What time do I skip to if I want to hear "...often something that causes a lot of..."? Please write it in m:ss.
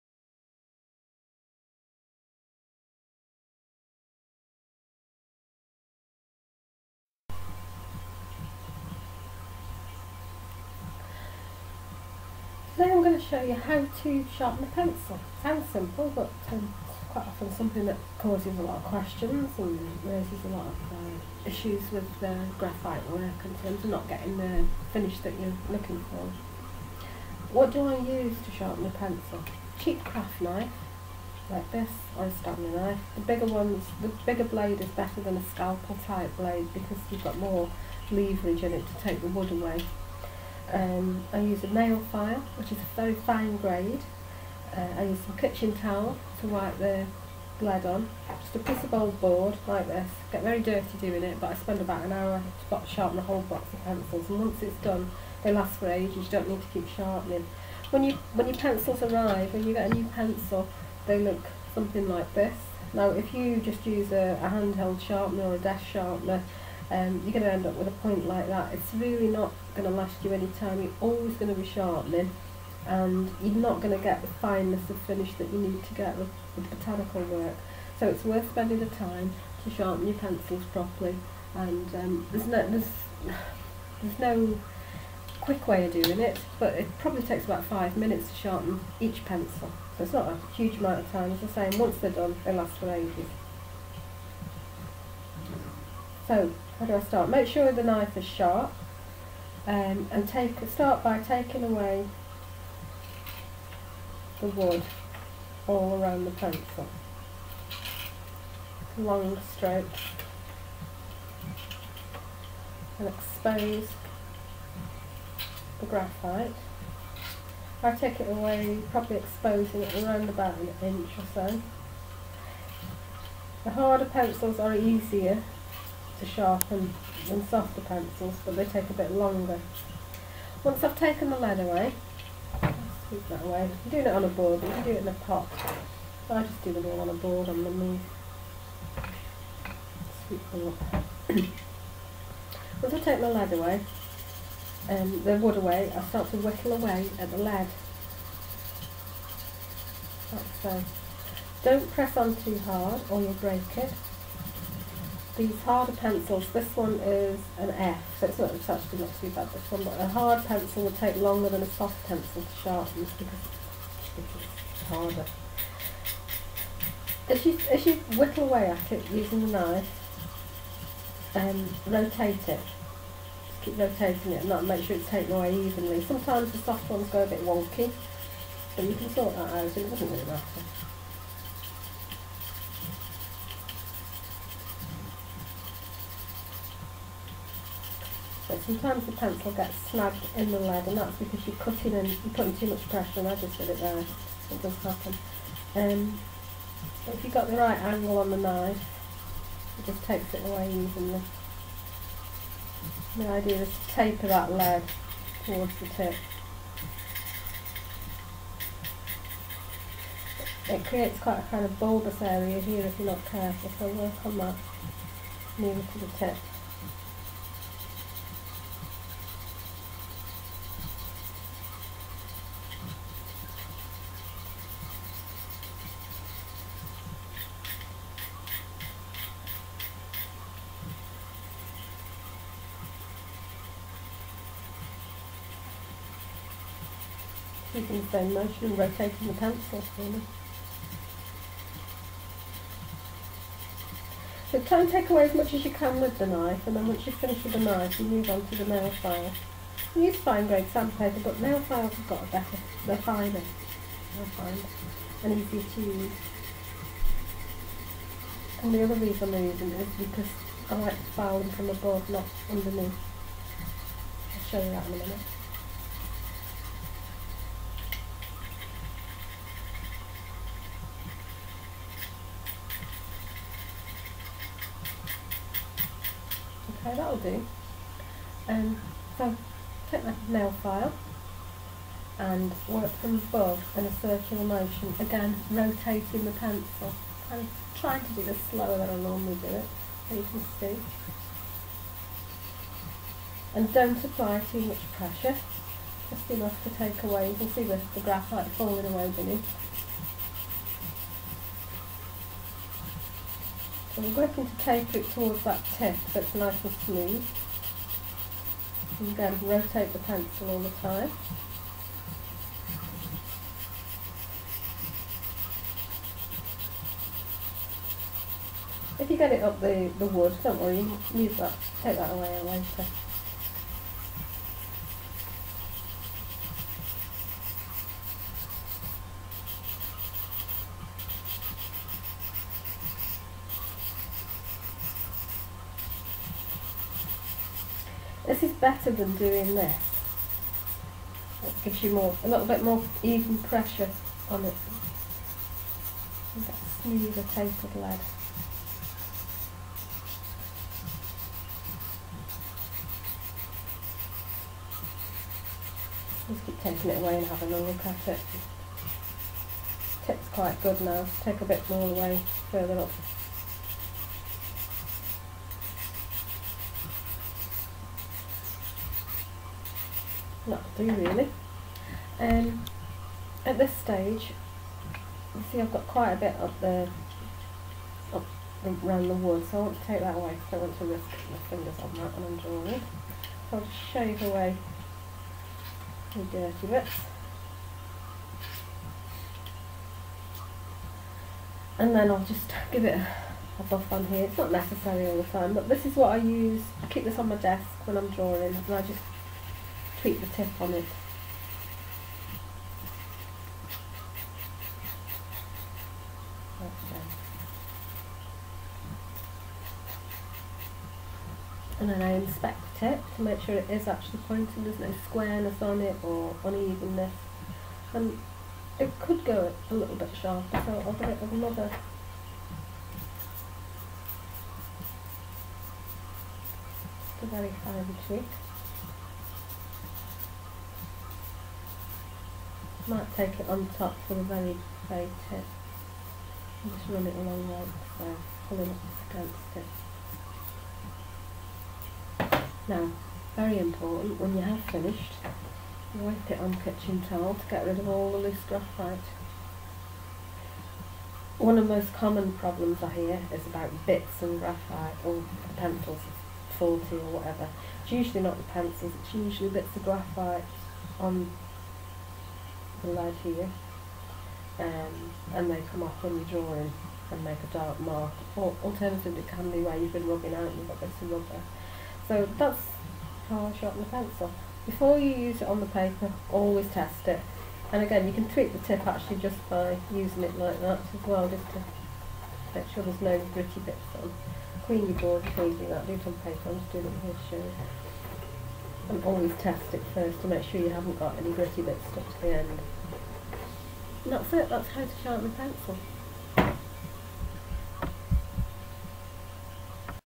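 0:17.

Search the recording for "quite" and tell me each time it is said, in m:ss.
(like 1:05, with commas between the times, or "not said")
0:17, 3:31, 6:00, 6:15.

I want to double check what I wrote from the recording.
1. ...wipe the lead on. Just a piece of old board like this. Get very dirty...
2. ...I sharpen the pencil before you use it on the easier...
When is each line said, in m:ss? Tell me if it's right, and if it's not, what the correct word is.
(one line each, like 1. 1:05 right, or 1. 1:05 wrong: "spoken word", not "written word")
1. 0:46 right
2. 7:53 wrong: "paper", not "easier".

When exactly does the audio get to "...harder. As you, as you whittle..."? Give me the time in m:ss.
2:44.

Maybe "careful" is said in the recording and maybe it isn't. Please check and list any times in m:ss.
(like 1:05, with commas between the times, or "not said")
3:33.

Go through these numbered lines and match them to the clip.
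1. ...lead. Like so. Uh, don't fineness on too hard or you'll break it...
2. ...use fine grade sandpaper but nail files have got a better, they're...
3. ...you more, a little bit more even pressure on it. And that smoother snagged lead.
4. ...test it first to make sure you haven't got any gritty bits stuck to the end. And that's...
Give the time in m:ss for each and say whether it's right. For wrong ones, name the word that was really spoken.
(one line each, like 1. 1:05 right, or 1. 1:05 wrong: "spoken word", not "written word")
1. 2:27 wrong: "press", not "fineness"
2. 4:10 right
3. 5:41 wrong: "tapered", not "snagged"
4. 8:09 right.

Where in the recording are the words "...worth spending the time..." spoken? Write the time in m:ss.
1:18.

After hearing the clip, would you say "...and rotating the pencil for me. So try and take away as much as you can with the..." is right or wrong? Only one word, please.
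right.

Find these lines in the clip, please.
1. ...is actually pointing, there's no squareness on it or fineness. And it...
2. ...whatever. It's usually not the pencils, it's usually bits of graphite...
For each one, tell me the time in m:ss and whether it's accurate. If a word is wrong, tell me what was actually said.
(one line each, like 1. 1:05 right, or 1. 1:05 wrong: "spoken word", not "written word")
1. 6:53 wrong: "unevenness", not "fineness"
2. 7:37 right.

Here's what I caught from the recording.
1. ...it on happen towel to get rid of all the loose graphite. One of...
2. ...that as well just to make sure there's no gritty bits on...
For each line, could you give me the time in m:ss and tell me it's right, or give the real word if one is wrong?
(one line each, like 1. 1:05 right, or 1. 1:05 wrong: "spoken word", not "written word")
1. 7:26 wrong: "kitchen", not "happen"
2. 8:00 right.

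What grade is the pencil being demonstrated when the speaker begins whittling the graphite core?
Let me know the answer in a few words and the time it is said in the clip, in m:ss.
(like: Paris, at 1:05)
F, at 2:37.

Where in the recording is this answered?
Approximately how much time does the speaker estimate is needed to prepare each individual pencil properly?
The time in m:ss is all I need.
1:27.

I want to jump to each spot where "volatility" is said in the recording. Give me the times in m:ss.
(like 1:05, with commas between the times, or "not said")
not said.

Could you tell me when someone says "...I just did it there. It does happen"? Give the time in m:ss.
3:13.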